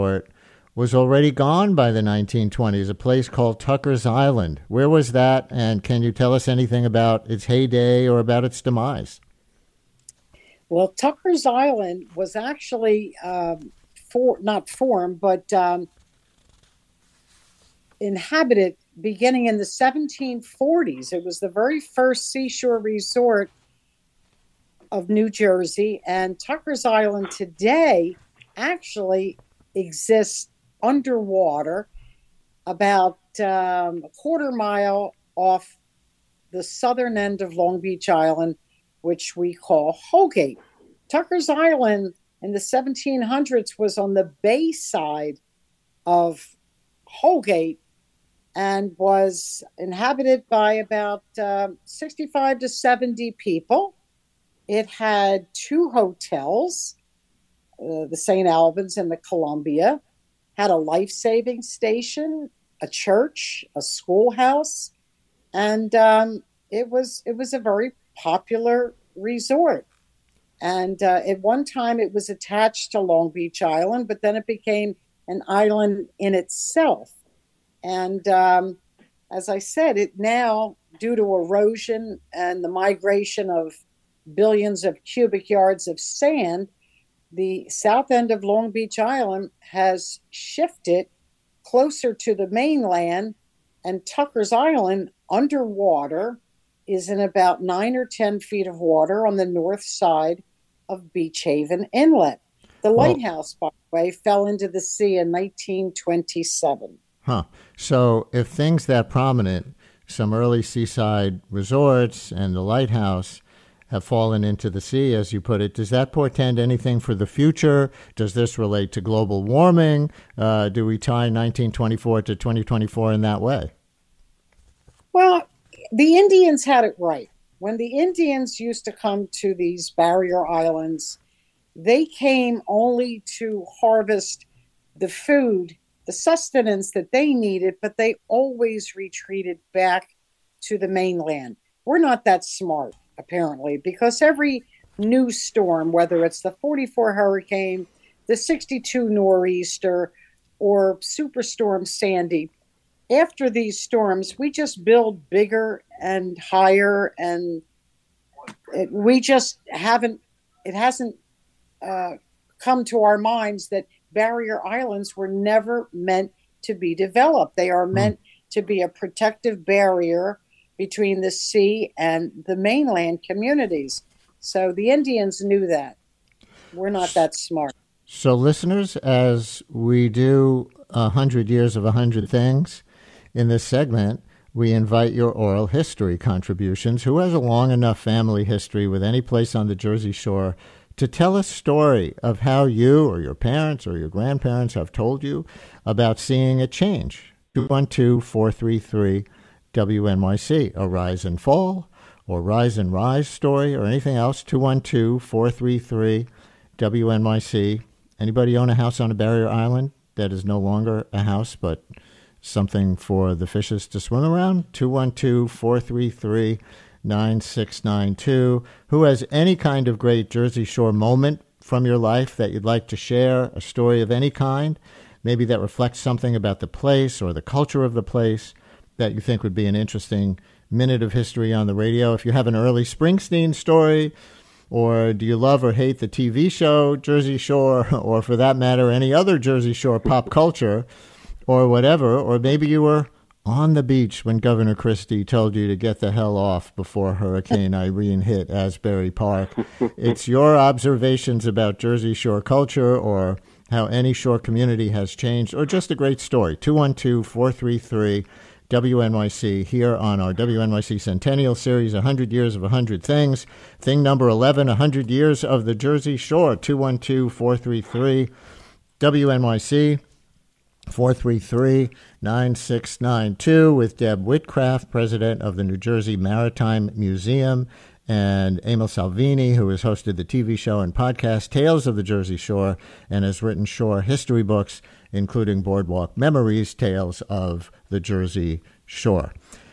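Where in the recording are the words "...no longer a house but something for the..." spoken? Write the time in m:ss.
3:30.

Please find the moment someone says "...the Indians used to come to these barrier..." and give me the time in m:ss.
2:07.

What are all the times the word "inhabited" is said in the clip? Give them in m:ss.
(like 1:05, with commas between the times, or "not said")
0:18, 0:49.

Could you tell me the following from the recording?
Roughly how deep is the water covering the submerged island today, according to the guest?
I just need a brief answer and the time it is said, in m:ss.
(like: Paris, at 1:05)
9 or 10 feet, at 1:37.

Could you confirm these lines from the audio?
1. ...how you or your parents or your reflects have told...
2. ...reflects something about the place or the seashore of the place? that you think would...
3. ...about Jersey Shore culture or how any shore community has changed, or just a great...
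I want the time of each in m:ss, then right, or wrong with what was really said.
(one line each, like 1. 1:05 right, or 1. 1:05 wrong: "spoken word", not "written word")
1. 3:12 wrong: "grandparents", not "reflects"
2. 3:45 wrong: "culture", not "seashore"
3. 4:11 right.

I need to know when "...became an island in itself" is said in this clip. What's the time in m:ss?
1:14.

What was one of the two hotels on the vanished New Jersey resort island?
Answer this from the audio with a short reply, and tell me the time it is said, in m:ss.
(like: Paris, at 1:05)
St. Albans, at 0:58.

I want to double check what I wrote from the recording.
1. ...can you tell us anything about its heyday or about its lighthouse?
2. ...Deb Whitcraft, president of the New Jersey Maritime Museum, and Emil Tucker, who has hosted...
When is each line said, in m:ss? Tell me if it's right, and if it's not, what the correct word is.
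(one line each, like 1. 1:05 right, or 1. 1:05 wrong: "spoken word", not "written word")
1. 0:05 wrong: "demise", not "lighthouse"
2. 4:33 wrong: "Salvini", not "Tucker".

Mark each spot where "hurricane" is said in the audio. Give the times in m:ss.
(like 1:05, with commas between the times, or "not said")
2:27, 4:07.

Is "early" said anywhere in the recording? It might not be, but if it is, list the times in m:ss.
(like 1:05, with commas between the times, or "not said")
1:50, 3:52.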